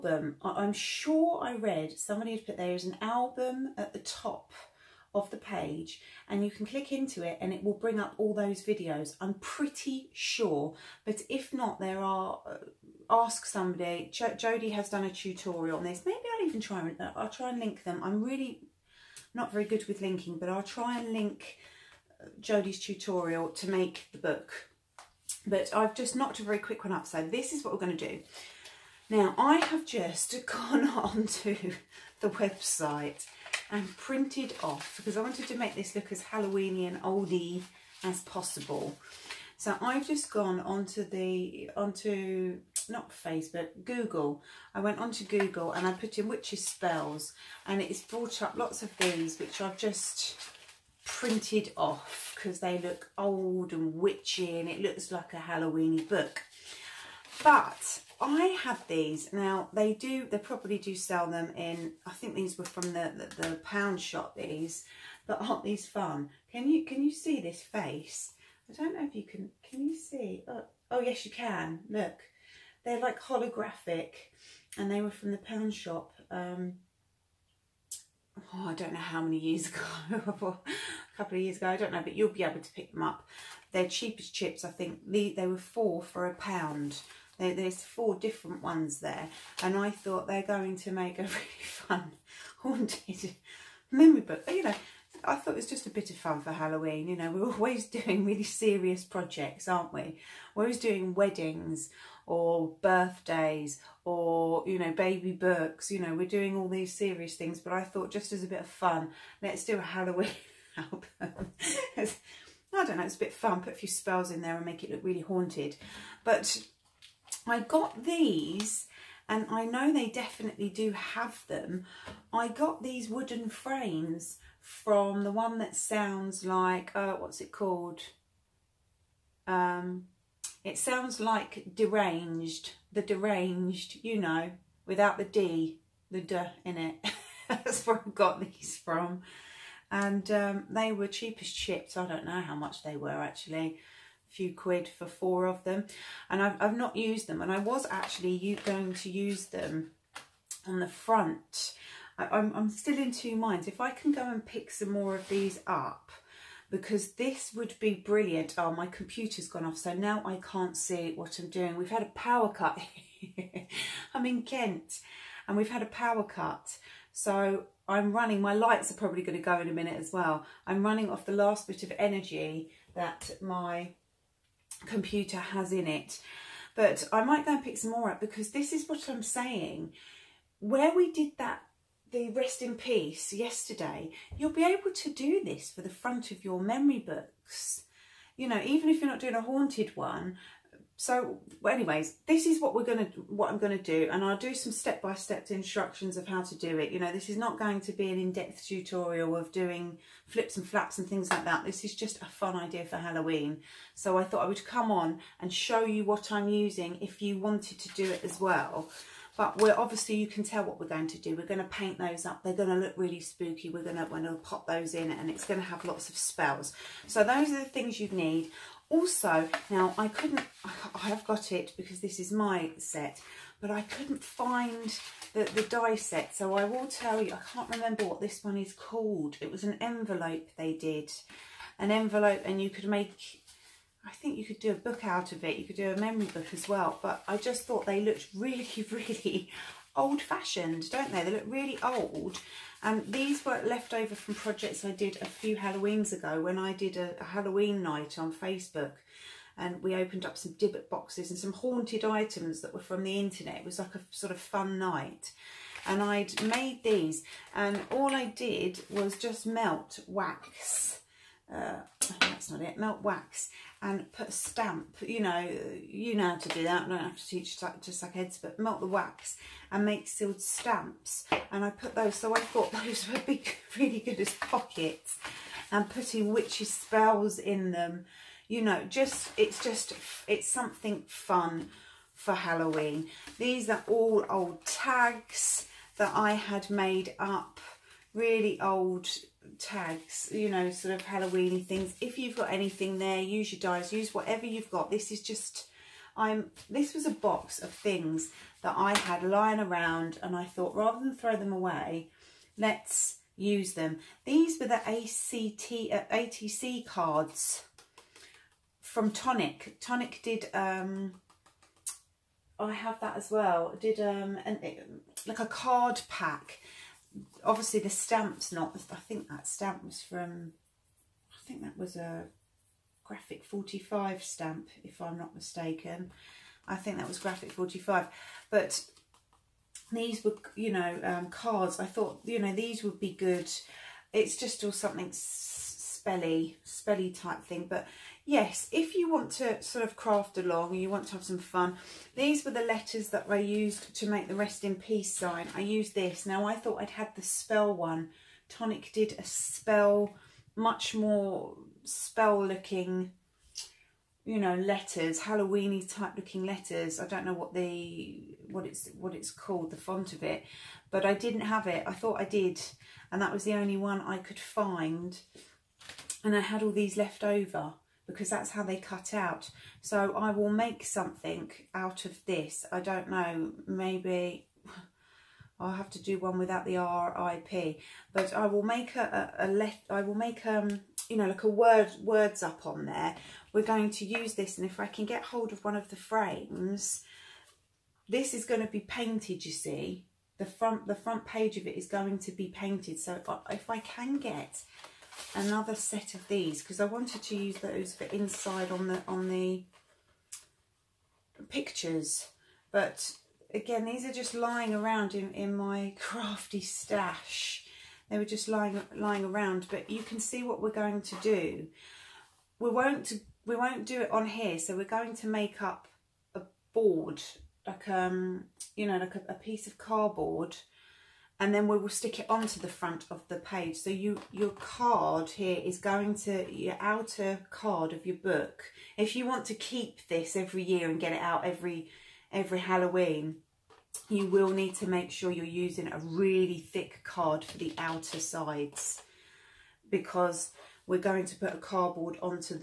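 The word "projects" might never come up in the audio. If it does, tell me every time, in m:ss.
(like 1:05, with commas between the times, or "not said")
1:39, 4:04.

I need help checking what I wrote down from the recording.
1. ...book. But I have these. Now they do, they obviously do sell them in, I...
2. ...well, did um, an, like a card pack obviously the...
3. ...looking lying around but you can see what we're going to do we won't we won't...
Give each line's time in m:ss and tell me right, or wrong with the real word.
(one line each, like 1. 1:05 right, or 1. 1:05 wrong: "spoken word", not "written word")
1. 0:56 wrong: "probably", not "obviously"
2. 5:13 right
3. 6:48 wrong: "lying", not "looking".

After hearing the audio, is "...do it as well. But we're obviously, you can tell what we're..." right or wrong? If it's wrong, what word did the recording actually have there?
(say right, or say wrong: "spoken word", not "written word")
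right.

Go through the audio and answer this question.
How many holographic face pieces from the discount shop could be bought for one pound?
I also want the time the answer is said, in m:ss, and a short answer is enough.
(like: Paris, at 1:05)
4, at 1:25.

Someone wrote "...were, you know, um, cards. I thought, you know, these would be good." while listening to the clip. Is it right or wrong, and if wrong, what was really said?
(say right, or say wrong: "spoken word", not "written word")
right.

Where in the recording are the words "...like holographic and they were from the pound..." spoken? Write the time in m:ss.
1:12.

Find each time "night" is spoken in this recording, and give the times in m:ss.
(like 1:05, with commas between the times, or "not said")
4:07, 4:14.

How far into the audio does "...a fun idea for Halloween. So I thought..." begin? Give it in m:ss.
3:22.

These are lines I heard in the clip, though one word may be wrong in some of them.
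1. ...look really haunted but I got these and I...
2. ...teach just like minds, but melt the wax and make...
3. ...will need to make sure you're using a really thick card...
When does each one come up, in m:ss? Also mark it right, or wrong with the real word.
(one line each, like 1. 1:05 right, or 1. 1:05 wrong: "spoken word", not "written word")
1. 1:54 right
2. 4:27 wrong: "heads", not "minds"
3. 7:14 right.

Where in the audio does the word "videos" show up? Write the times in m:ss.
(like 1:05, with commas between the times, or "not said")
0:08.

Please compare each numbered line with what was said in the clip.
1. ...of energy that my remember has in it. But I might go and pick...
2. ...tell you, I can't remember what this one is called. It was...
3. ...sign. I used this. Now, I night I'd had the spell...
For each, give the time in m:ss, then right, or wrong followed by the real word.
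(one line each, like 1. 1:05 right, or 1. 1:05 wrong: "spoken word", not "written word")
1. 2:51 wrong: "computer", not "remember"
2. 3:46 right
3. 5:45 wrong: "thought", not "night".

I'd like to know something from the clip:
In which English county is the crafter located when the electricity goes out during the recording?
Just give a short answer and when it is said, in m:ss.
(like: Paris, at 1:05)
Kent, at 2:44.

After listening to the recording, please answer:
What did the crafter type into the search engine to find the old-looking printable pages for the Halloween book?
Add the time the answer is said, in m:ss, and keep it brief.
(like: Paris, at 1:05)
witches spells, at 0:46.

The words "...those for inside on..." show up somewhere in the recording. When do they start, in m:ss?
6:37.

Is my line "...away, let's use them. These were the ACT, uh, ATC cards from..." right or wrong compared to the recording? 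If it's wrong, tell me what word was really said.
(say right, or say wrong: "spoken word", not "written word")
right.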